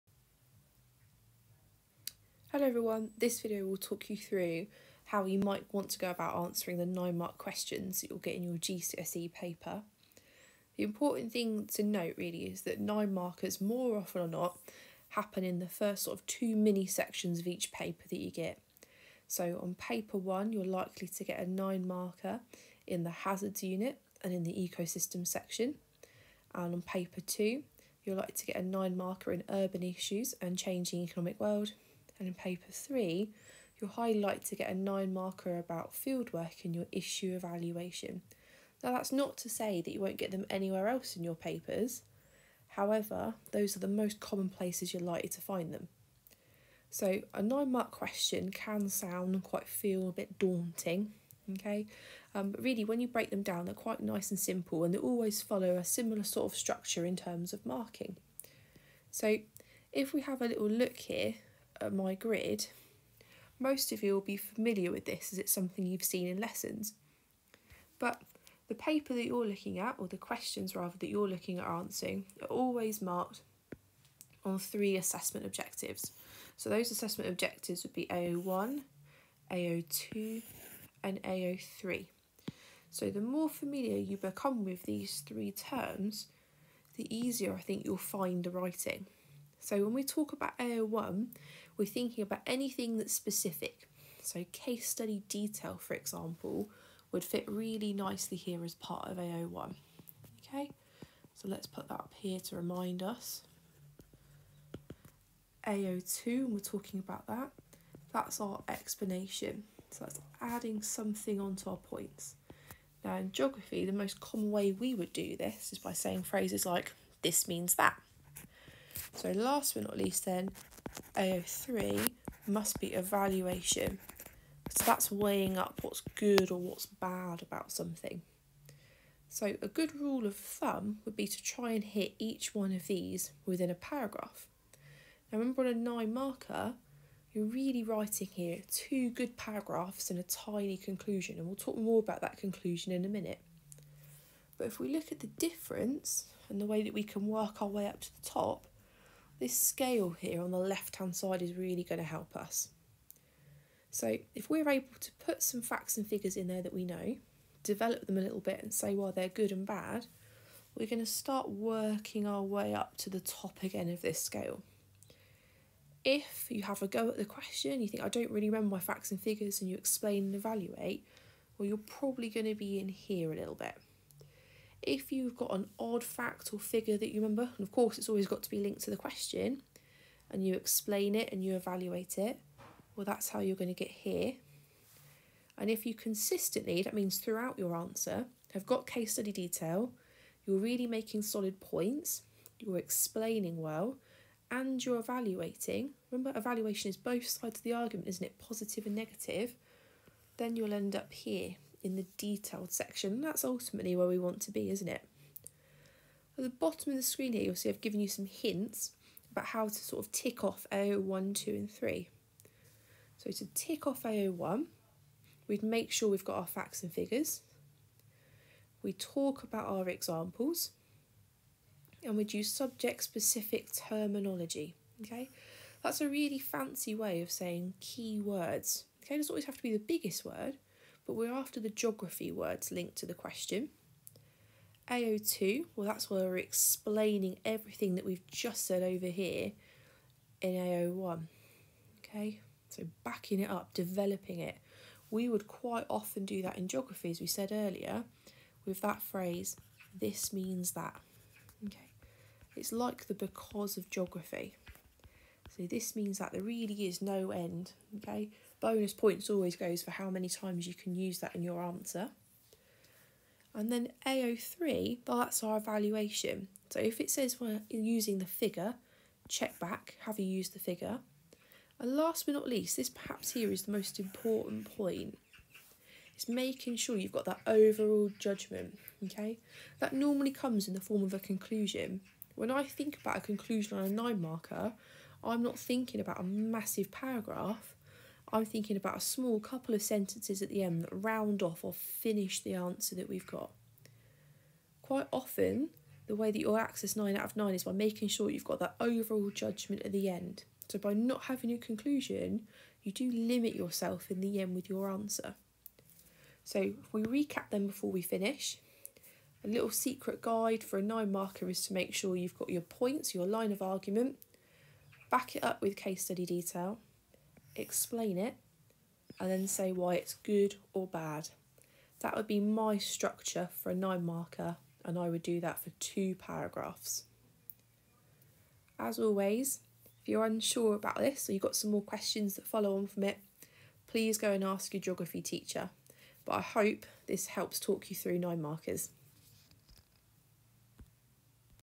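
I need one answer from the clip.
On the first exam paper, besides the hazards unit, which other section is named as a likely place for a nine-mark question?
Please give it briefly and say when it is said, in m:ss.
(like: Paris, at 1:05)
Ecosystem section, at 0:24.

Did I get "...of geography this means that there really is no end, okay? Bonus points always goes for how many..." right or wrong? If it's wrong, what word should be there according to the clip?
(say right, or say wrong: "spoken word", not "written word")
right.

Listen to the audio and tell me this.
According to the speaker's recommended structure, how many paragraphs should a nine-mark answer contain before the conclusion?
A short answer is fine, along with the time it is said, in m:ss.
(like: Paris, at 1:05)
2, at 5:25.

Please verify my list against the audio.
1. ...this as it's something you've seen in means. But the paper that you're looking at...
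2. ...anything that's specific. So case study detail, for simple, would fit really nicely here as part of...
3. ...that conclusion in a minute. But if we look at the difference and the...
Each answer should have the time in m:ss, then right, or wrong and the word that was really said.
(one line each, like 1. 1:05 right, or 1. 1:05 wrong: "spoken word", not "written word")
1. 1:05 wrong: "lessons", not "means"
2. 1:32 wrong: "example", not "simple"
3. 2:22 right.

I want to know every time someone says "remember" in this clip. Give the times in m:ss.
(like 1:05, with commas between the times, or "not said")
2:15, 2:48, 2:57, 3:16.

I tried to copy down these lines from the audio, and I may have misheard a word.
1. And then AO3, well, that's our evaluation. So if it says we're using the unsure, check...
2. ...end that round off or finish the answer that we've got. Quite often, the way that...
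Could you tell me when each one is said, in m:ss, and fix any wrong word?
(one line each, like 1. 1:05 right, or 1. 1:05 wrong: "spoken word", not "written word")
1. 4:23 wrong: "figure", not "unsure"
2. 4:50 right.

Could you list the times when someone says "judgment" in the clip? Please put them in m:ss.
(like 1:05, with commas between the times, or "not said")
4:38, 4:59.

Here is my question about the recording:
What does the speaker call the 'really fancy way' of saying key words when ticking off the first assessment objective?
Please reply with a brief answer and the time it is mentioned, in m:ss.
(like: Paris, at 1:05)
Subject-specific terminology, at 3:42.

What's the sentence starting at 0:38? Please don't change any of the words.
Now that's not to say that you won't get them anywhere else in your papers.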